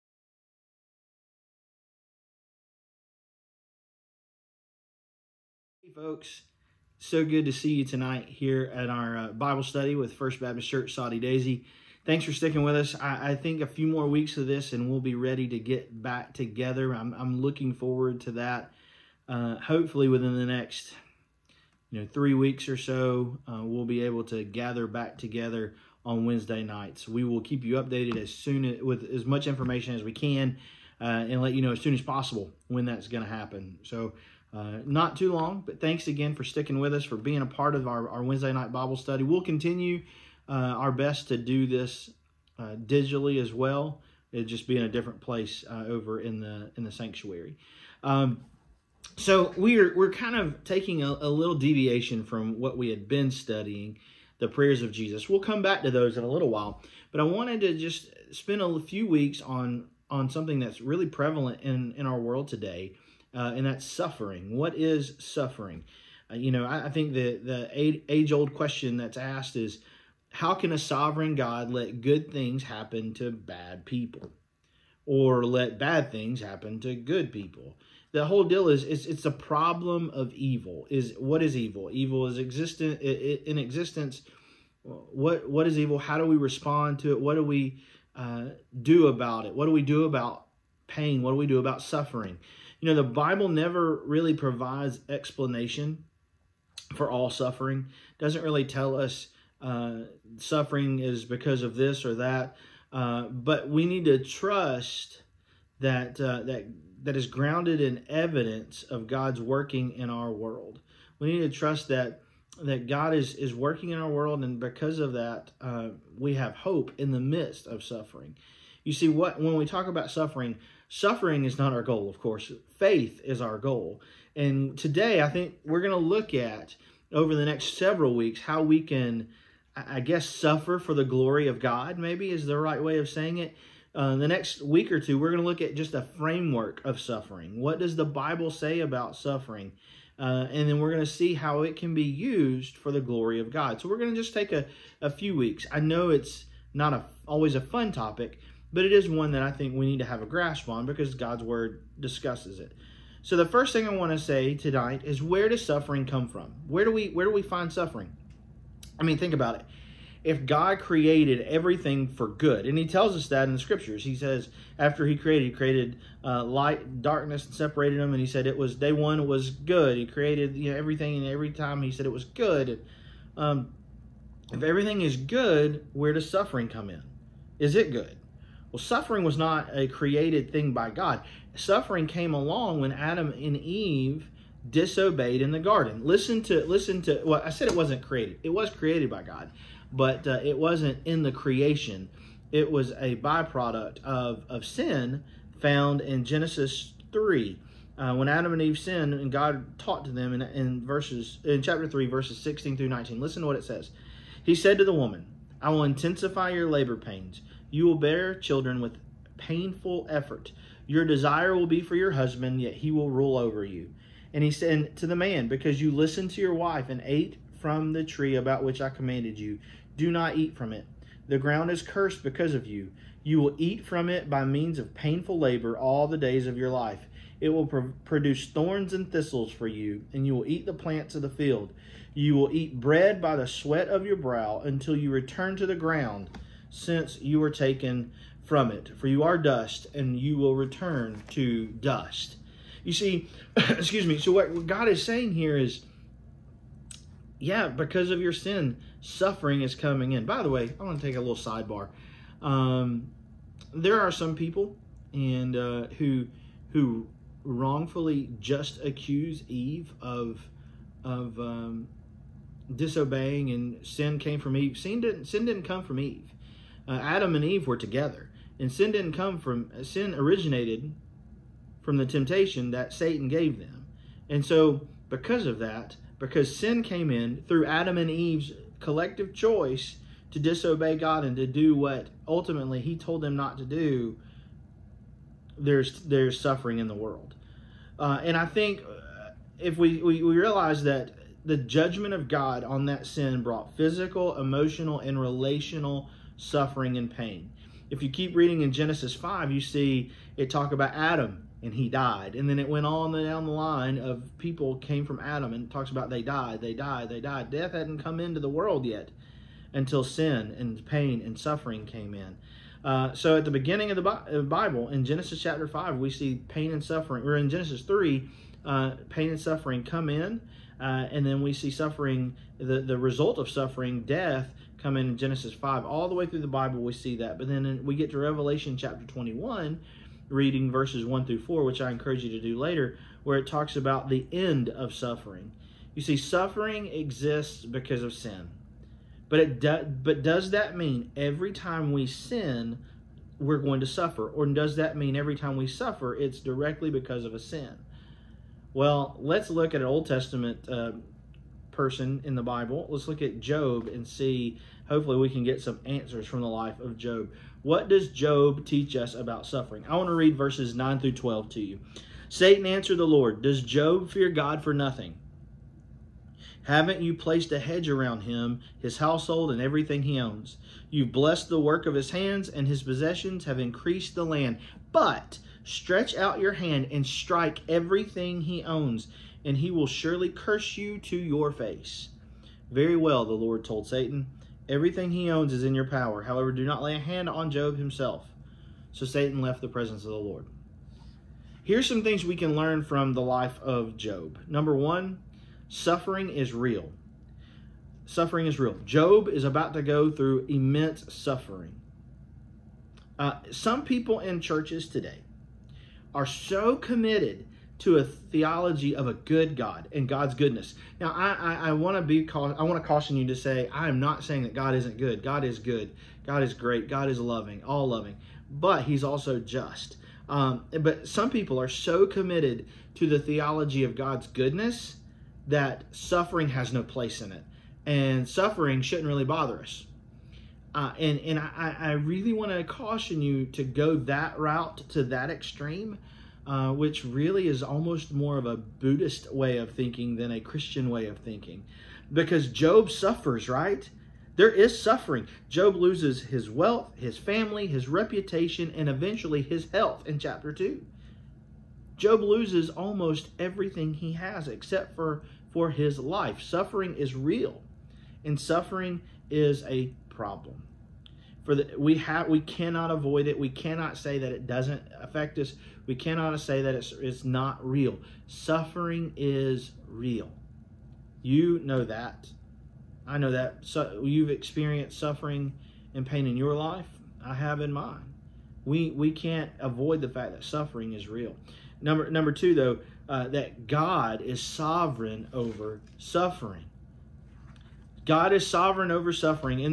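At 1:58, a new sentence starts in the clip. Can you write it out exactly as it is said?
You see, what when we talk about suffering, Suffering is not our goal, of course.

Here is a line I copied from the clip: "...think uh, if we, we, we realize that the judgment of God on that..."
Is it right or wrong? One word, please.
right.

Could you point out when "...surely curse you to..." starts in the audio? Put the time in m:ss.
6:19.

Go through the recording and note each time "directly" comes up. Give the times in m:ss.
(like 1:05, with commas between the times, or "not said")
5:46.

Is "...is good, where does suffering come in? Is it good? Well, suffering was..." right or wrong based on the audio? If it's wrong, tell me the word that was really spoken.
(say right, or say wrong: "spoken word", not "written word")
right.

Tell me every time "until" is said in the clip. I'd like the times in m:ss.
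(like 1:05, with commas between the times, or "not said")
3:54, 5:09.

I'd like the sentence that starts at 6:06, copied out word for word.
Haven't you placed a hedge around him, his household, and everything he owns?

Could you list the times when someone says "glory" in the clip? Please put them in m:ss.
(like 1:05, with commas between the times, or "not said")
2:11, 2:23.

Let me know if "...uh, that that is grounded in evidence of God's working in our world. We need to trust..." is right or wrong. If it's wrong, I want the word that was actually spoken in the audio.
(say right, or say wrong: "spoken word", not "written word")
right.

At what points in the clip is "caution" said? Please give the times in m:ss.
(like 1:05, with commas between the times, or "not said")
6:52, 7:12.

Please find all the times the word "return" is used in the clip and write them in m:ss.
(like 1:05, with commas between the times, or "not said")
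3:55, 4:00.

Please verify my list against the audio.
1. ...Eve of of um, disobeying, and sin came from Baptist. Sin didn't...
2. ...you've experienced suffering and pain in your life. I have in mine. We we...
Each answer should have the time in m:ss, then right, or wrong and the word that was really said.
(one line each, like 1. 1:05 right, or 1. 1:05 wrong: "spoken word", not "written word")
1. 4:19 wrong: "Eve", not "Baptist"
2. 7:54 right.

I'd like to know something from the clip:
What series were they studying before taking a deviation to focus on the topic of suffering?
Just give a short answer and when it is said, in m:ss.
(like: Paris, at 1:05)
the prayers of Jesus, at 0:54.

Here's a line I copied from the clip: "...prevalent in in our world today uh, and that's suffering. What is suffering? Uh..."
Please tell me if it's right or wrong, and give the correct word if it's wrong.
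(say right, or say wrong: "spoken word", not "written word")
right.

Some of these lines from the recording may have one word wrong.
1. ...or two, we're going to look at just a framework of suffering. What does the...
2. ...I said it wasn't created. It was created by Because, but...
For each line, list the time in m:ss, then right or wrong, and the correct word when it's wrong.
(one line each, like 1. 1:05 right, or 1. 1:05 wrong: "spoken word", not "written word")
1. 2:14 right
2. 3:07 wrong: "God", not "Because".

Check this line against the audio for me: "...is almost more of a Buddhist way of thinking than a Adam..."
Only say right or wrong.
wrong.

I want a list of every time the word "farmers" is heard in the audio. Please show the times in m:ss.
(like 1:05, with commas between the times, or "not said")
not said.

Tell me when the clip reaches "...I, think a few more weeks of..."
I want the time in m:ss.
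0:13.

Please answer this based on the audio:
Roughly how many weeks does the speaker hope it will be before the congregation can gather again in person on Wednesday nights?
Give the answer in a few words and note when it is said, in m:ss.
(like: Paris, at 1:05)
3, at 0:22.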